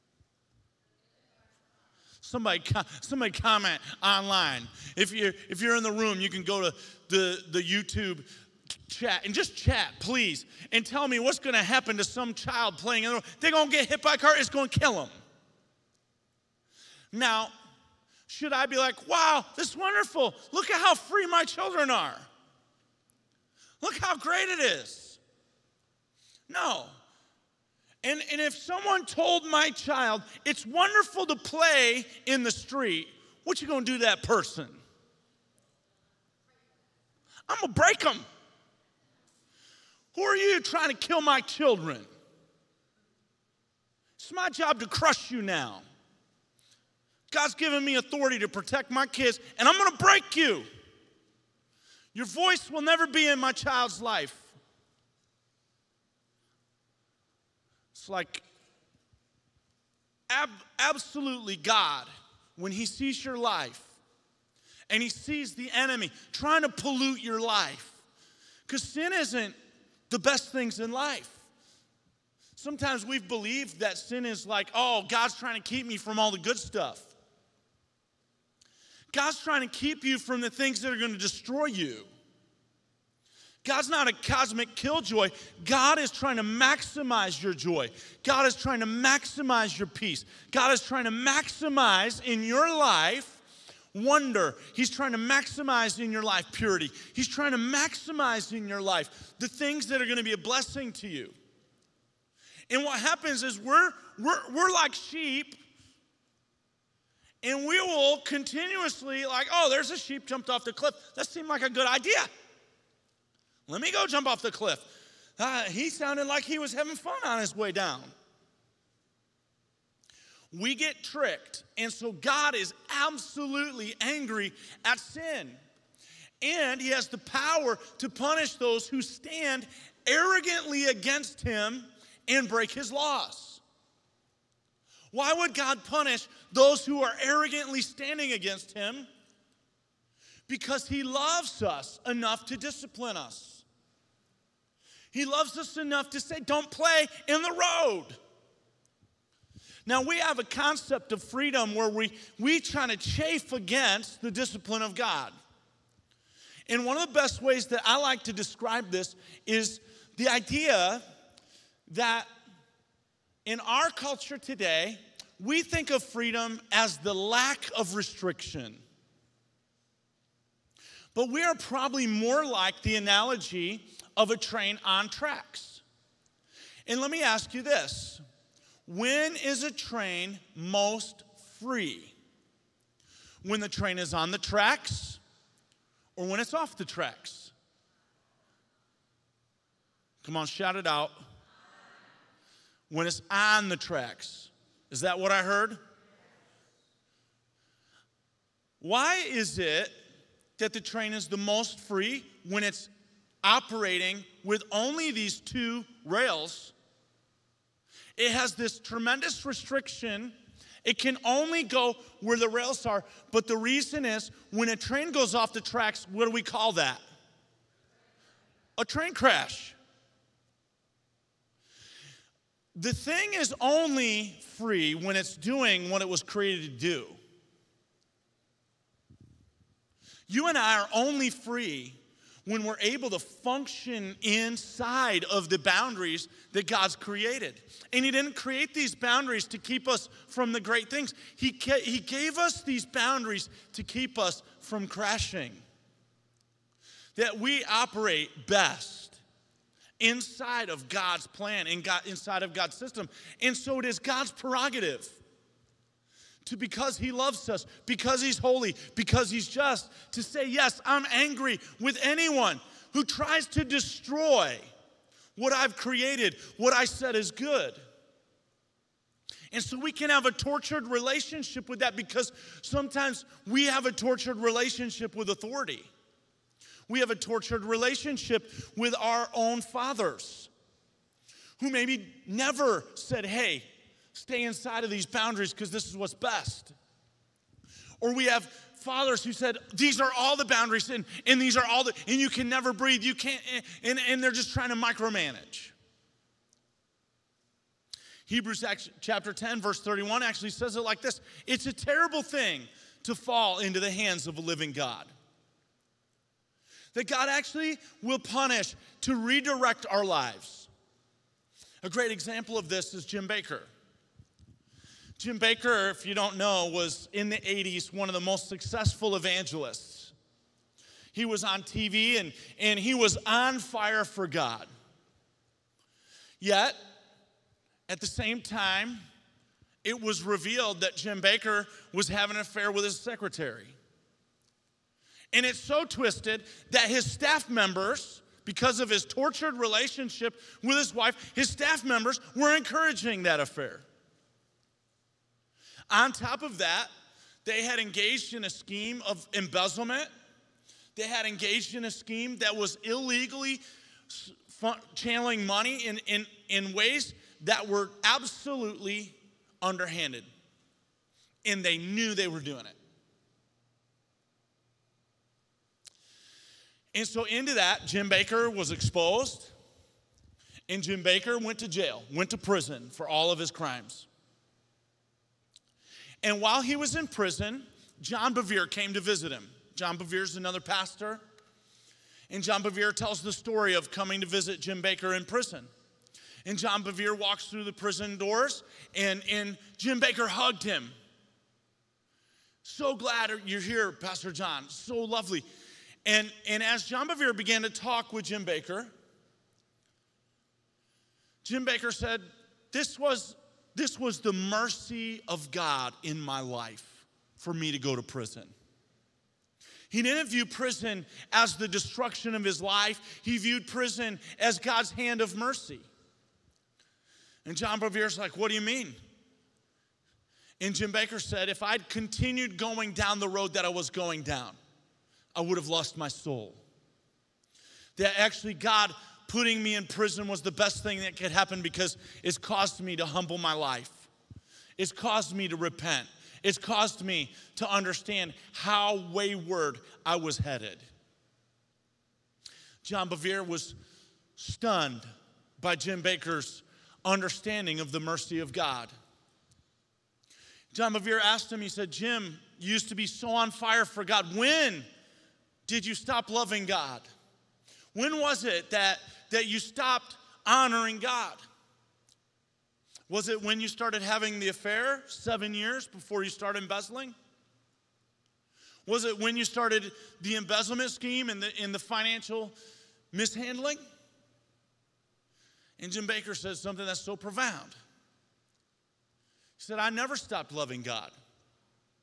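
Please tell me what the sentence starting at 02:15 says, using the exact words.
Why would God punish those who are arrogantly standing against Him?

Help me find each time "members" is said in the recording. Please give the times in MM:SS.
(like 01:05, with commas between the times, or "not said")
05:37, 05:41.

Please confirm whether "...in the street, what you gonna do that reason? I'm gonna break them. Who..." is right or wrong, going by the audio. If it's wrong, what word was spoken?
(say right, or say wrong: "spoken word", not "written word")
wrong: "person", not "reason".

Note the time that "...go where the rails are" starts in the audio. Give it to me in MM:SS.
03:31.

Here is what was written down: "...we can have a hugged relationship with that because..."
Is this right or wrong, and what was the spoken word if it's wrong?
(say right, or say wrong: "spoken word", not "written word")
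wrong: "tortured", not "hugged".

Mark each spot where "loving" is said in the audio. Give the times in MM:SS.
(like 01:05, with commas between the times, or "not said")
07:36, 08:00.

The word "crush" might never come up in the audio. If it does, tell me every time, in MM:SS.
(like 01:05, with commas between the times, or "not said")
00:44.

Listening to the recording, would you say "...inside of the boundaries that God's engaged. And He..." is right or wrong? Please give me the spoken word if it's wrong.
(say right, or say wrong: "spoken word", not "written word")
wrong: "created", not "engaged".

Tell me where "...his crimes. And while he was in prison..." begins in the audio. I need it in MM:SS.
06:13.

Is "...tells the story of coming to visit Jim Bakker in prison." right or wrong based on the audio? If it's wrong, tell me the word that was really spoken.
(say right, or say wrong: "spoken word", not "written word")
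right.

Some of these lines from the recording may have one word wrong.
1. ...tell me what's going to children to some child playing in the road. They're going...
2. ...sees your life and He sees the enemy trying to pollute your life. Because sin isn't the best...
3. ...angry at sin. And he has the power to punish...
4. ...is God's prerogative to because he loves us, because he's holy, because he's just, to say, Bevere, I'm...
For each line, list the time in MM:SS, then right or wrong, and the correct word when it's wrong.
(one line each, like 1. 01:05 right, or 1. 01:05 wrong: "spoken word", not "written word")
1. 00:10 wrong: "happen", not "children"
2. 01:02 right
3. 02:03 right
4. 04:13 wrong: "Yes", not "Bevere".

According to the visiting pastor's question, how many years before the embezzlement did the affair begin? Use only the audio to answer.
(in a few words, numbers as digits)
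7 years.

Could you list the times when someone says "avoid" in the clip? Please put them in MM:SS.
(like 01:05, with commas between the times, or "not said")
not said.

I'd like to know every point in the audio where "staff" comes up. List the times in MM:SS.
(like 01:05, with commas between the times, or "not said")
05:37, 05:41.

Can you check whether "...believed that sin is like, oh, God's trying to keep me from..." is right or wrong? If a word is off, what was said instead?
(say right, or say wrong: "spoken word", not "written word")
right.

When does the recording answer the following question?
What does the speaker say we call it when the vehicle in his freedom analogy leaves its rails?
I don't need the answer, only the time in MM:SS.
03:38.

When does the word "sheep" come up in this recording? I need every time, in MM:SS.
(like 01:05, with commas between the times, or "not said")
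01:44, 01:49.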